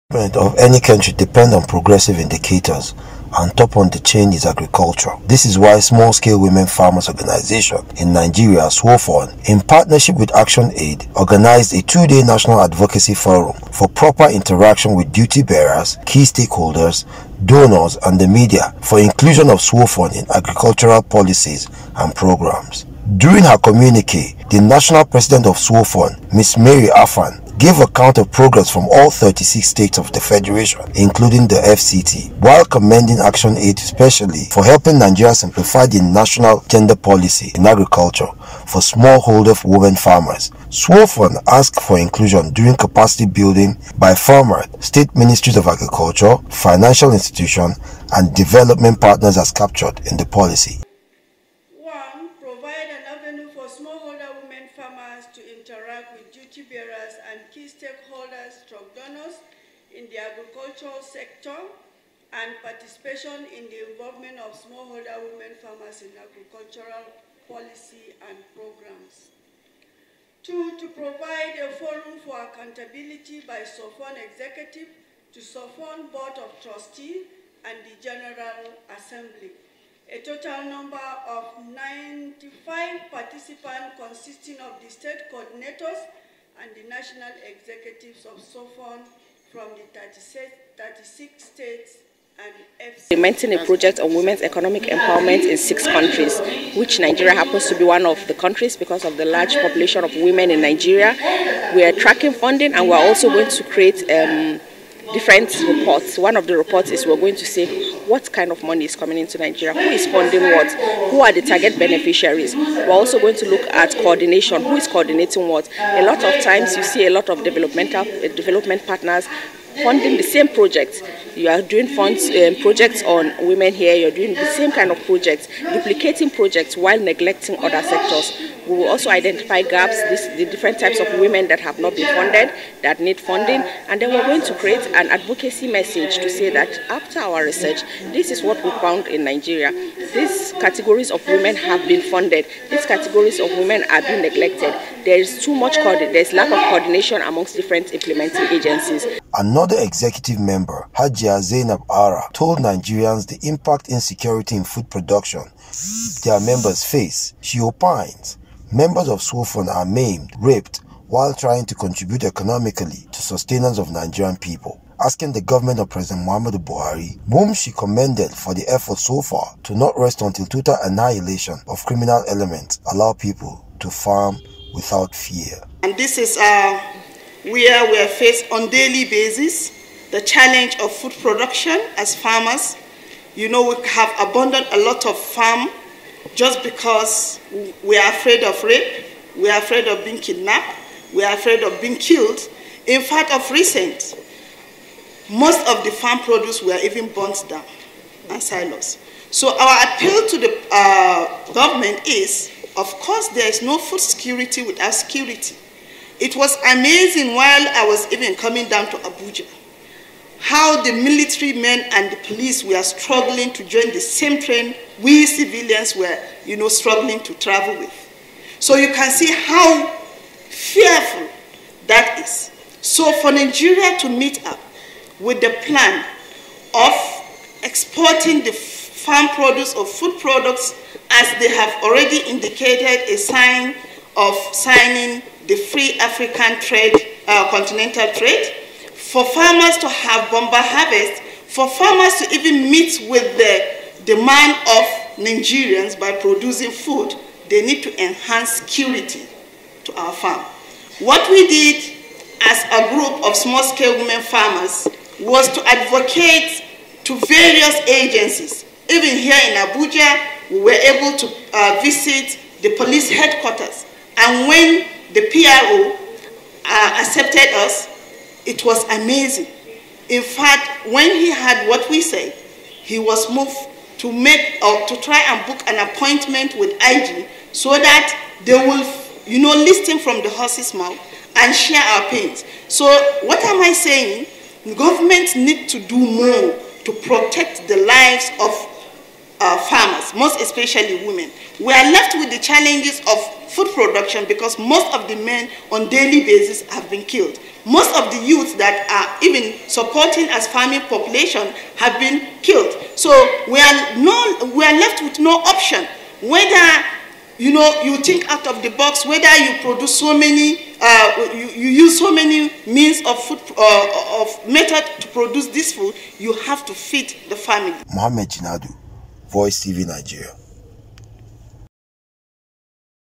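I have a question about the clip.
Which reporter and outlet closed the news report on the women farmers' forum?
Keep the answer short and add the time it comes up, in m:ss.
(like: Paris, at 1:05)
Mohammed Jinadu, Voice TV Nigeria, at 5:17.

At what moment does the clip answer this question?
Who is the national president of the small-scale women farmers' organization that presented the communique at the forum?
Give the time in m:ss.
0:26.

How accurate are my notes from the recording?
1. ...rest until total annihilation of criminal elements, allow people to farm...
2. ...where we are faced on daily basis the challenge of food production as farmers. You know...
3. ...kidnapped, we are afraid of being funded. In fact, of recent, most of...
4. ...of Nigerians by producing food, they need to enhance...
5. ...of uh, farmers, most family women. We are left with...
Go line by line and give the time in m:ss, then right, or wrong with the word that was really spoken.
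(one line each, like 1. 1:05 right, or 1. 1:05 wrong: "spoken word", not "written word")
1. 2:49 right
2. 2:57 right
3. 3:10 wrong: "killed", not "funded"
4. 4:04 right
5. 4:48 wrong: "especially", not "family".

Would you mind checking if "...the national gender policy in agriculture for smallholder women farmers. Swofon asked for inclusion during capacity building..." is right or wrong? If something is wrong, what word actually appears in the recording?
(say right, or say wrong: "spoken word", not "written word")
right.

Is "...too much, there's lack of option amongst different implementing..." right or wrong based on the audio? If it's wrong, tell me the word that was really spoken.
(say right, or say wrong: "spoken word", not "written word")
wrong: "coordination", not "option".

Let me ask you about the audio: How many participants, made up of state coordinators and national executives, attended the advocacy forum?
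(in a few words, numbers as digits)
95.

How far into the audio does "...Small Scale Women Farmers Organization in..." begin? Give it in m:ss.
0:05.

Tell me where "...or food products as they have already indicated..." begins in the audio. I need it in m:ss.
3:49.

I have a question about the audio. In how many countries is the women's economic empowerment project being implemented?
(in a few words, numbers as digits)
6.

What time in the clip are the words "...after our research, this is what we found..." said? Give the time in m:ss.
2:16.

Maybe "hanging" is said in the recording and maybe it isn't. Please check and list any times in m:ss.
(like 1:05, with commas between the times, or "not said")
not said.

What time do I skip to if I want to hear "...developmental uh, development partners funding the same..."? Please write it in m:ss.
1:57.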